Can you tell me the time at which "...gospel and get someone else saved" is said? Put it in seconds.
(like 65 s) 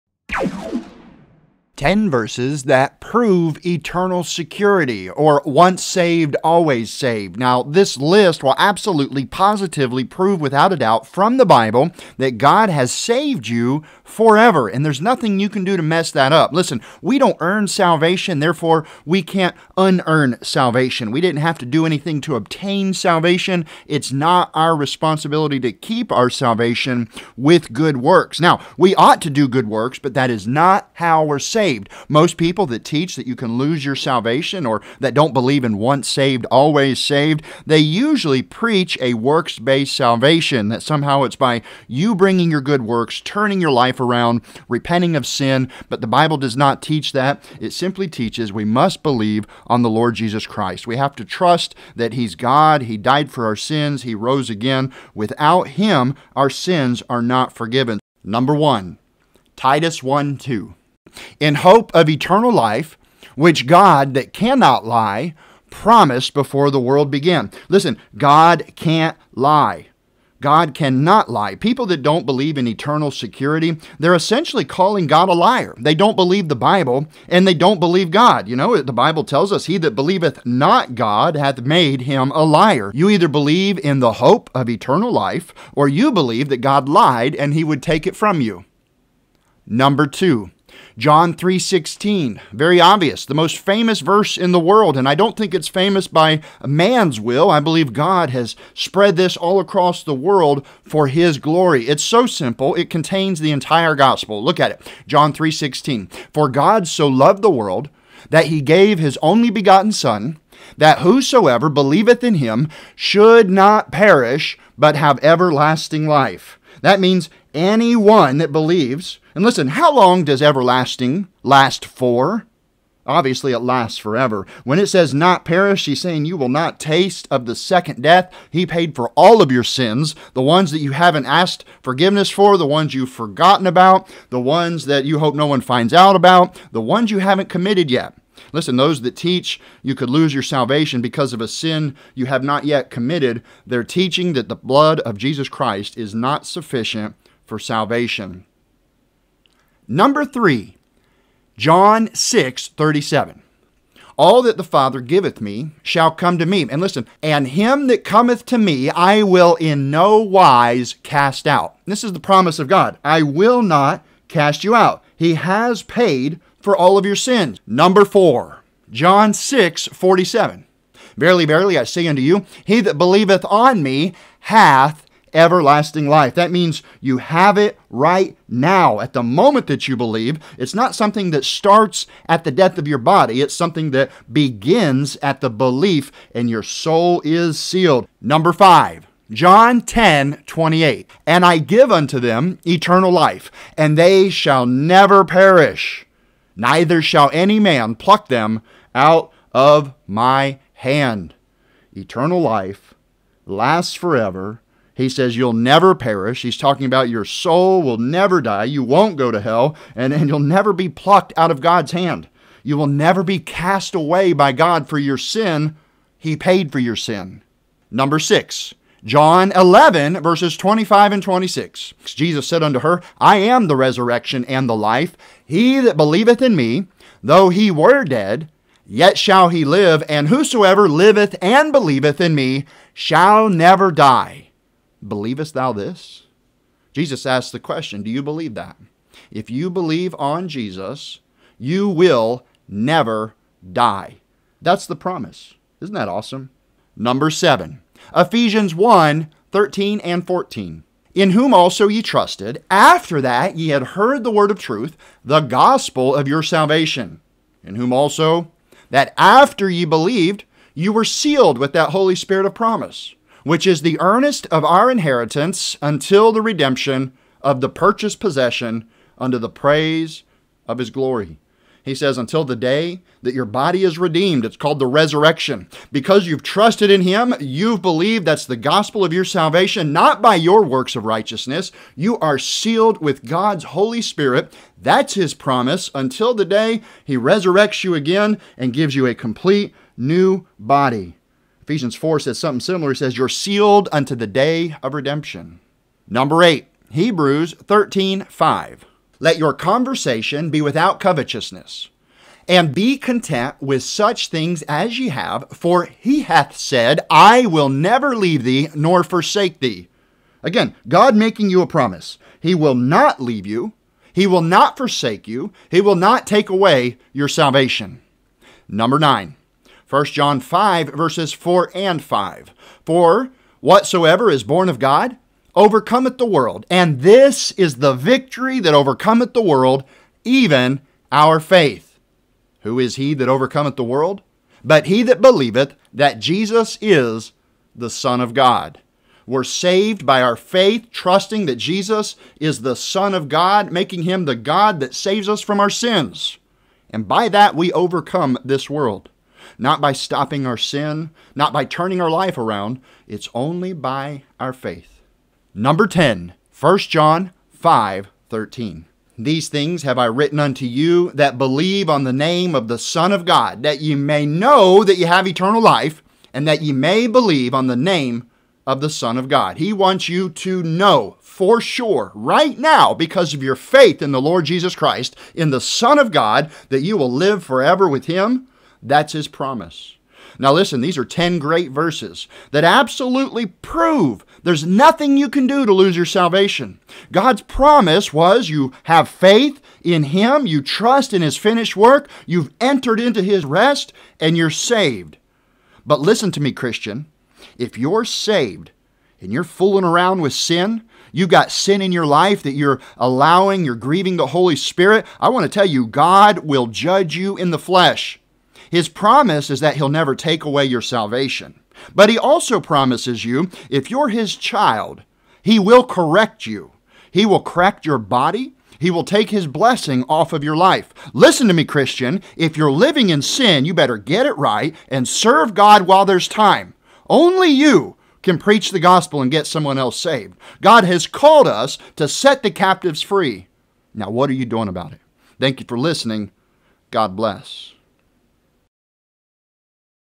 428 s.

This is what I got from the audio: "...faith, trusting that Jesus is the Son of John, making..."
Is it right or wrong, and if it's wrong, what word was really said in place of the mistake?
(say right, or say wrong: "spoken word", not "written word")
wrong: "God", not "John".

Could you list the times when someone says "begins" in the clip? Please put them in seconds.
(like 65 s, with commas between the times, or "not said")
184 s.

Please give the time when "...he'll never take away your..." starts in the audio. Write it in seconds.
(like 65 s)
409 s.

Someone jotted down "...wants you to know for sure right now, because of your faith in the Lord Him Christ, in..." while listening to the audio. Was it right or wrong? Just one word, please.
wrong.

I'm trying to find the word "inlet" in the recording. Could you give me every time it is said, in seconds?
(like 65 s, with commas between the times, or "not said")
not said.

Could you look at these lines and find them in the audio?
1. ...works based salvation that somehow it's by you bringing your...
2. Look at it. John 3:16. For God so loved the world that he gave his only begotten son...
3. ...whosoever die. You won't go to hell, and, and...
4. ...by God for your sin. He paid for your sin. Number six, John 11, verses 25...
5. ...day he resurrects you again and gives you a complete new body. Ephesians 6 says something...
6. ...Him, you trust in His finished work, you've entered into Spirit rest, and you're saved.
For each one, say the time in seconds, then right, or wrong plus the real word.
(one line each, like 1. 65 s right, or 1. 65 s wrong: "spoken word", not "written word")
1. 39 s right
2. 104 s right
3. 207 s wrong: "never", not "whosoever"
4. 214 s right
5. 286 s wrong: "4", not "6"
6. 390 s wrong: "His", not "Spirit".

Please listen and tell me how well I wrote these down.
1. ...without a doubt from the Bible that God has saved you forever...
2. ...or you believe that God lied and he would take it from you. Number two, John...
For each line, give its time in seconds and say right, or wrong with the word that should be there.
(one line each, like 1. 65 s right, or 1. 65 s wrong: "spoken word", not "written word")
1. 10 s right
2. 85 s right.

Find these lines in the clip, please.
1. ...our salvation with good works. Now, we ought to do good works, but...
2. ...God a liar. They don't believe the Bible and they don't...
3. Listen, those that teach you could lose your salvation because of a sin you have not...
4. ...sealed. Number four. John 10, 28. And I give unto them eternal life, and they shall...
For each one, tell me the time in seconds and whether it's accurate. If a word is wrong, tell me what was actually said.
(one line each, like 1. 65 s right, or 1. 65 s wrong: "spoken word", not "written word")
1. 26 s right
2. 75 s right
3. 138 s right
4. 187 s wrong: "five", not "four".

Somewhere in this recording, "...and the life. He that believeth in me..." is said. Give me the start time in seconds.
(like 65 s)
224 s.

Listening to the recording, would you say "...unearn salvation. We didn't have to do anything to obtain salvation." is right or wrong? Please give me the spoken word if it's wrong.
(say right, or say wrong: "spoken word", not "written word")
right.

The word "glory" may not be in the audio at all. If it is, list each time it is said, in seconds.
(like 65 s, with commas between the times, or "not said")
101 s, 270 s.